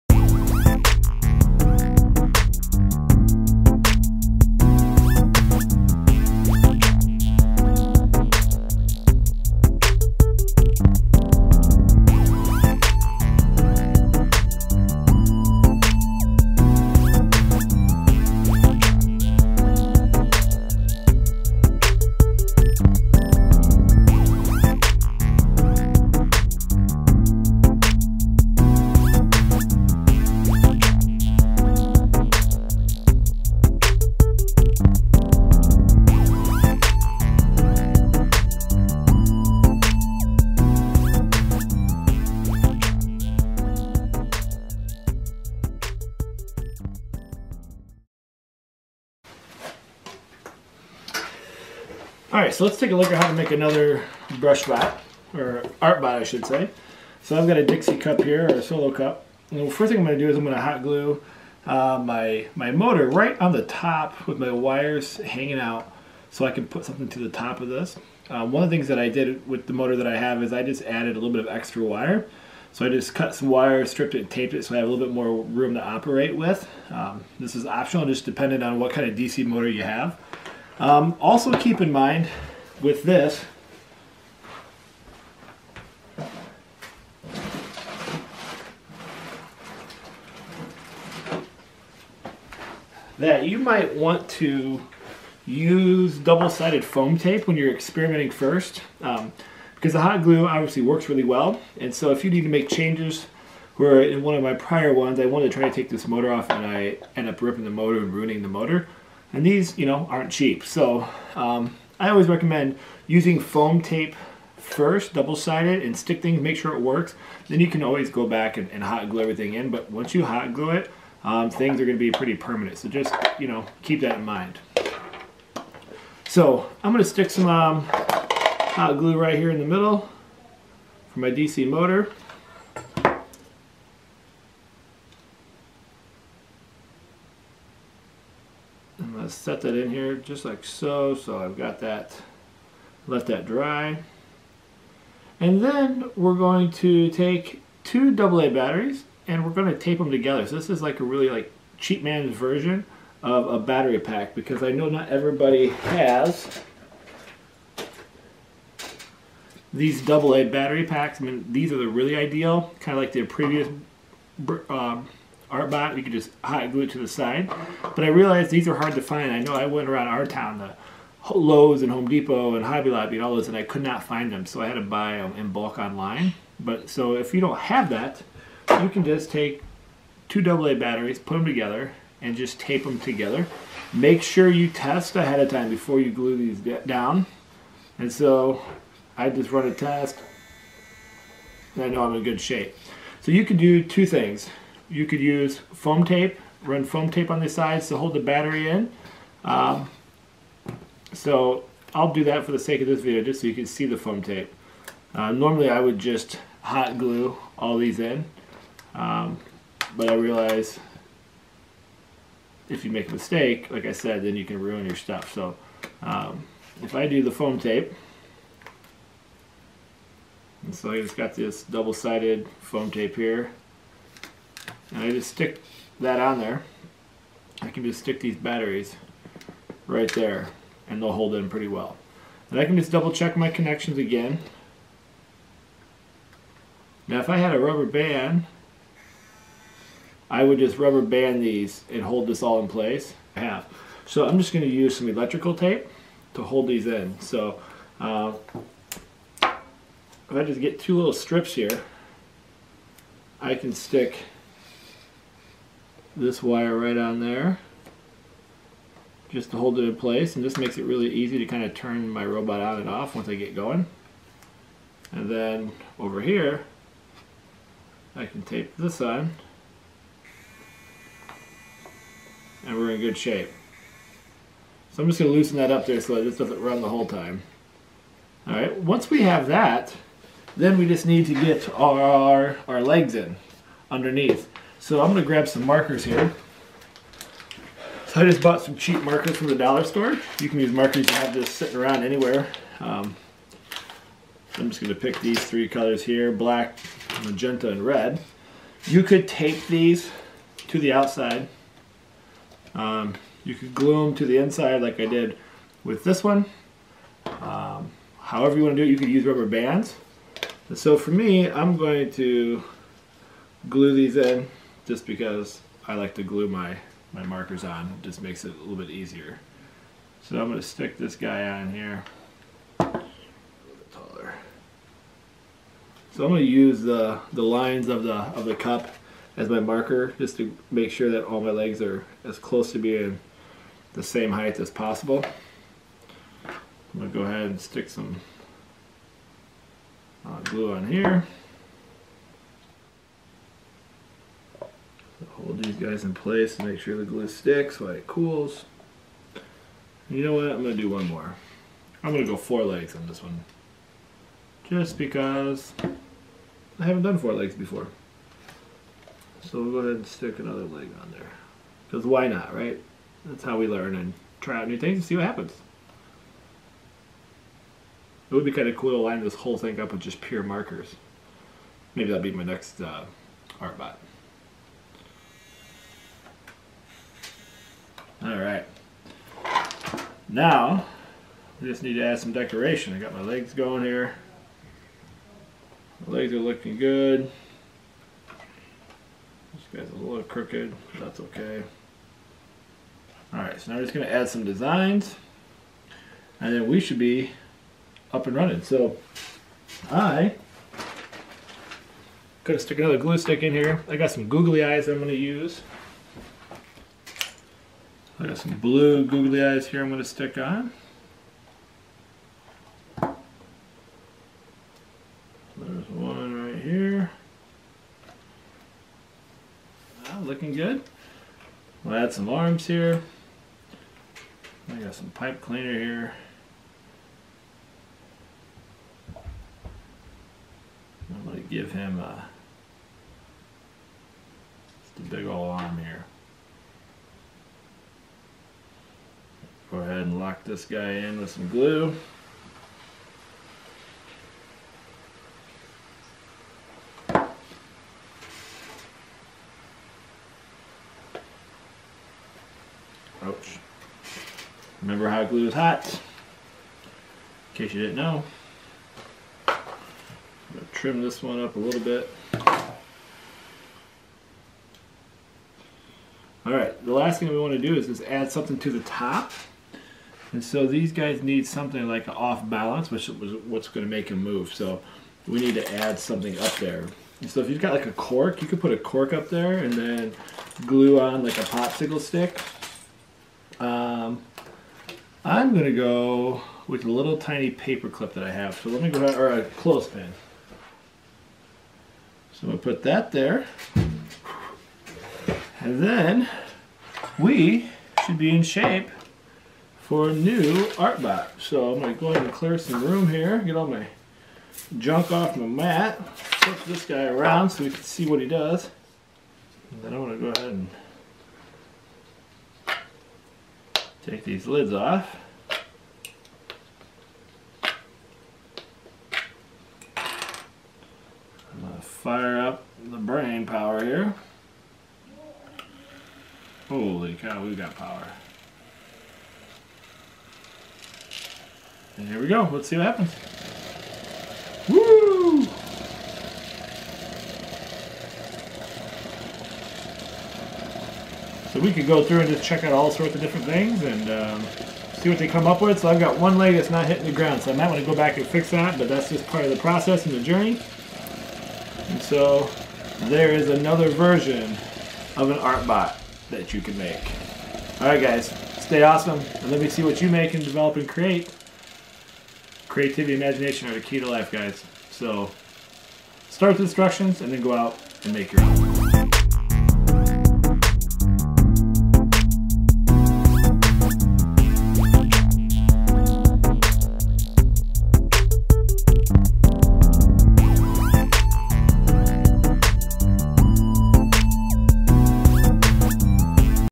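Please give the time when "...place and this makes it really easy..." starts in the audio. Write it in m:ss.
4:19.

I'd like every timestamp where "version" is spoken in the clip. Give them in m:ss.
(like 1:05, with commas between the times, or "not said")
2:32, 9:13.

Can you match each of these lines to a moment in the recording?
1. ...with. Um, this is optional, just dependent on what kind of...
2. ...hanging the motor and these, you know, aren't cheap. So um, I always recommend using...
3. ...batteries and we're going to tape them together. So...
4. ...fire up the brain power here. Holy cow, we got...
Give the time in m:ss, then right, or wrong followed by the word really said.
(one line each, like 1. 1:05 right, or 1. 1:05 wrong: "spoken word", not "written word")
1. 1:16 right
2. 1:48 wrong: "ruining", not "hanging"
3. 2:28 right
4. 8:41 right.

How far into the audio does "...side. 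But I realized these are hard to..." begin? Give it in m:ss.
2:47.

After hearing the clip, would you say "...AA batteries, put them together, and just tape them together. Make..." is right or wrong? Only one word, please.
right.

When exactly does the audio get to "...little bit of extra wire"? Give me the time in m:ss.
1:11.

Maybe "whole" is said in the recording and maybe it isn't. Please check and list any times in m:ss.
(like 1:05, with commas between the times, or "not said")
4:36, 6:09.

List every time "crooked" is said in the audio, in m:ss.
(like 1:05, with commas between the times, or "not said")
6:30.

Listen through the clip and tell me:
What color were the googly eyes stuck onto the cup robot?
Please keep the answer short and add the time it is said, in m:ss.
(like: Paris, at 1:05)
Blue, at 6:48.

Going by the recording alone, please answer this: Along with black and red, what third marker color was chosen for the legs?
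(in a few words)
Magenta.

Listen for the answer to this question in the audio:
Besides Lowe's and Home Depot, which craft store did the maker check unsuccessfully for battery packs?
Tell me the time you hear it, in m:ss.
2:52.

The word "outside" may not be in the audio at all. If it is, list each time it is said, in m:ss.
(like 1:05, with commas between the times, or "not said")
5:00.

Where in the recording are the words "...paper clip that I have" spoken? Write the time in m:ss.
8:07.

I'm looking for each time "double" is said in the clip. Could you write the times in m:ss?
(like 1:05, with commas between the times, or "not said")
1:36, 1:55, 3:41, 3:52.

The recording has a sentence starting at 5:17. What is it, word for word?
It just makes it a little bit easier.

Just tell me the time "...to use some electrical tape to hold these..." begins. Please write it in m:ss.
4:04.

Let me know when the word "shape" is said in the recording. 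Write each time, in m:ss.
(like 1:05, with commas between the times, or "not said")
3:12, 4:33, 8:18.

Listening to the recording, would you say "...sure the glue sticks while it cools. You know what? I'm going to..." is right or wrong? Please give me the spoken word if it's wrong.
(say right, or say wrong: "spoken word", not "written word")
right.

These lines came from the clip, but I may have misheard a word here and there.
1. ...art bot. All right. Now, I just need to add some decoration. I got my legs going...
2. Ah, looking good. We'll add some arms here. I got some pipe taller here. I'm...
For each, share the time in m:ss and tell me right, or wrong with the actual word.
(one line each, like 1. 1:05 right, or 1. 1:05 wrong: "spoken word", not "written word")
1. 6:13 right
2. 7:00 wrong: "cleaner", not "taller".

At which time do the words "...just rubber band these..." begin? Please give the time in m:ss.
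4:00.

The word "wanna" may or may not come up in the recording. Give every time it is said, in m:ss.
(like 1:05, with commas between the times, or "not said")
5:08, 7:47.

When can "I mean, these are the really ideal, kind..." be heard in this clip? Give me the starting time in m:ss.
2:41.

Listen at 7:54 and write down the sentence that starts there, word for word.
So we need to add something up there.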